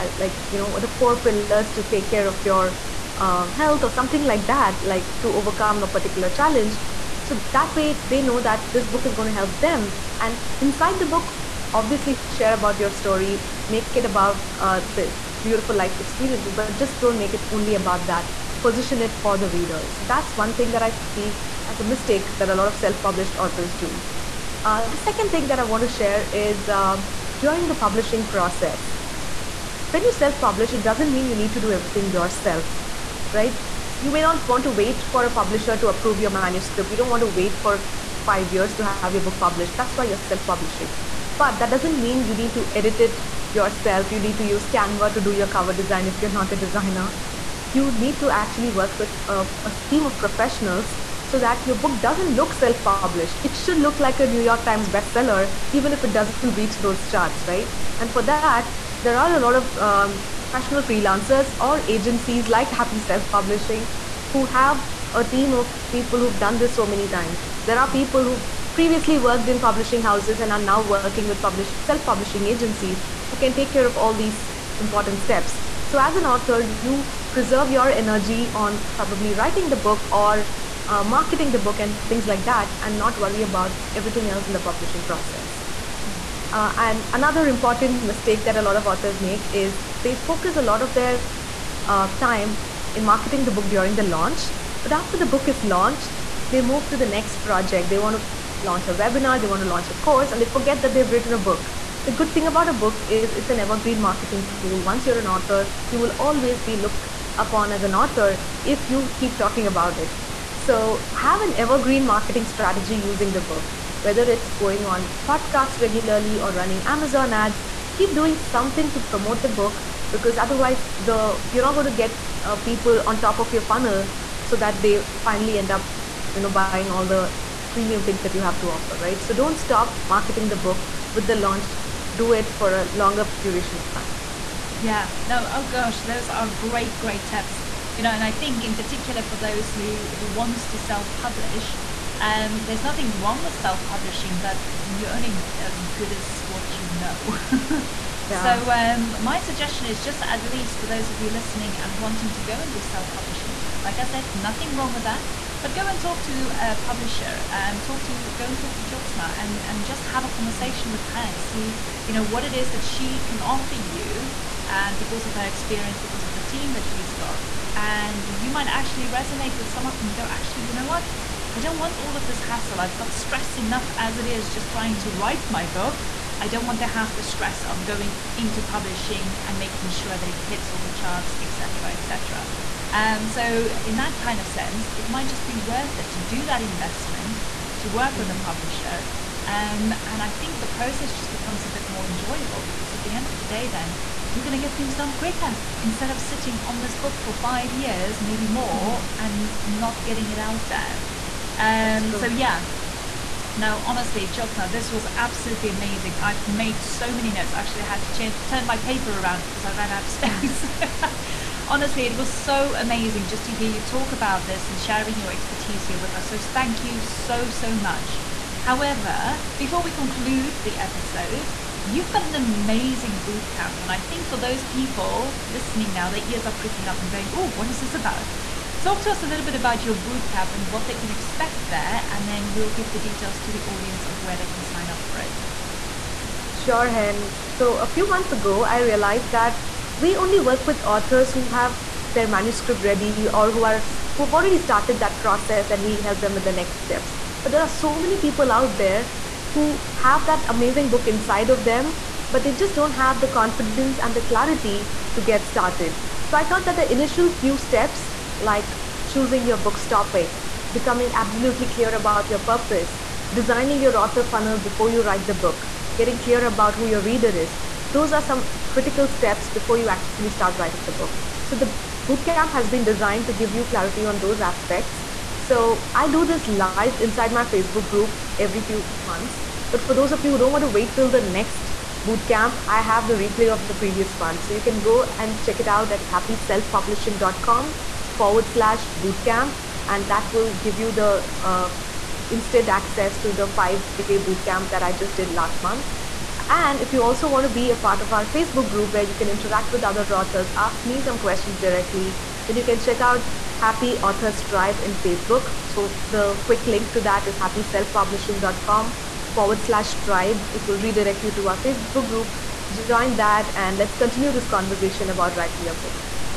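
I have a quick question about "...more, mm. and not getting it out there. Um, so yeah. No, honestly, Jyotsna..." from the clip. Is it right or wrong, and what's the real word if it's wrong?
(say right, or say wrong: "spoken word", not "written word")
right.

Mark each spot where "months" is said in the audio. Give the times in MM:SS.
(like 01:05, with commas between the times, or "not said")
03:58, 04:39, 04:55.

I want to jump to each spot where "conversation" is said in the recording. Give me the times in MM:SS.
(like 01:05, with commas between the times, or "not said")
02:40, 05:14.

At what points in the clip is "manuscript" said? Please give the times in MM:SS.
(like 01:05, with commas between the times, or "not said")
00:36, 04:02.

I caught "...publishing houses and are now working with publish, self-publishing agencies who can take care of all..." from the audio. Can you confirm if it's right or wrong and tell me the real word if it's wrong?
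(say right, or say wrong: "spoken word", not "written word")
right.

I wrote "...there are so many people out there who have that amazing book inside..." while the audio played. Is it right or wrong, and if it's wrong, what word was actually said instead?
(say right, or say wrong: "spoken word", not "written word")
right.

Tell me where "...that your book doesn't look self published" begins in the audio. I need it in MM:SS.
00:51.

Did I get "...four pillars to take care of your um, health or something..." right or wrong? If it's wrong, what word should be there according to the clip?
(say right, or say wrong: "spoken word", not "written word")
right.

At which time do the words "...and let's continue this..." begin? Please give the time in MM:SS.
05:13.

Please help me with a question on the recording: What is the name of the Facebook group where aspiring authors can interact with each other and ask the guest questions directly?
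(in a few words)
Happy Authors Tribe.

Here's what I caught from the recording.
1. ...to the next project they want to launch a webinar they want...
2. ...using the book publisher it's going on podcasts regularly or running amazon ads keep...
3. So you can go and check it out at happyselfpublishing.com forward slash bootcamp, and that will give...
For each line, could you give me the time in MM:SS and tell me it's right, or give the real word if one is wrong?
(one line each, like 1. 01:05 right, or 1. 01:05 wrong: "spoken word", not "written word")
1. 01:36 right
2. 01:53 wrong: "whether", not "publisher"
3. 04:44 right.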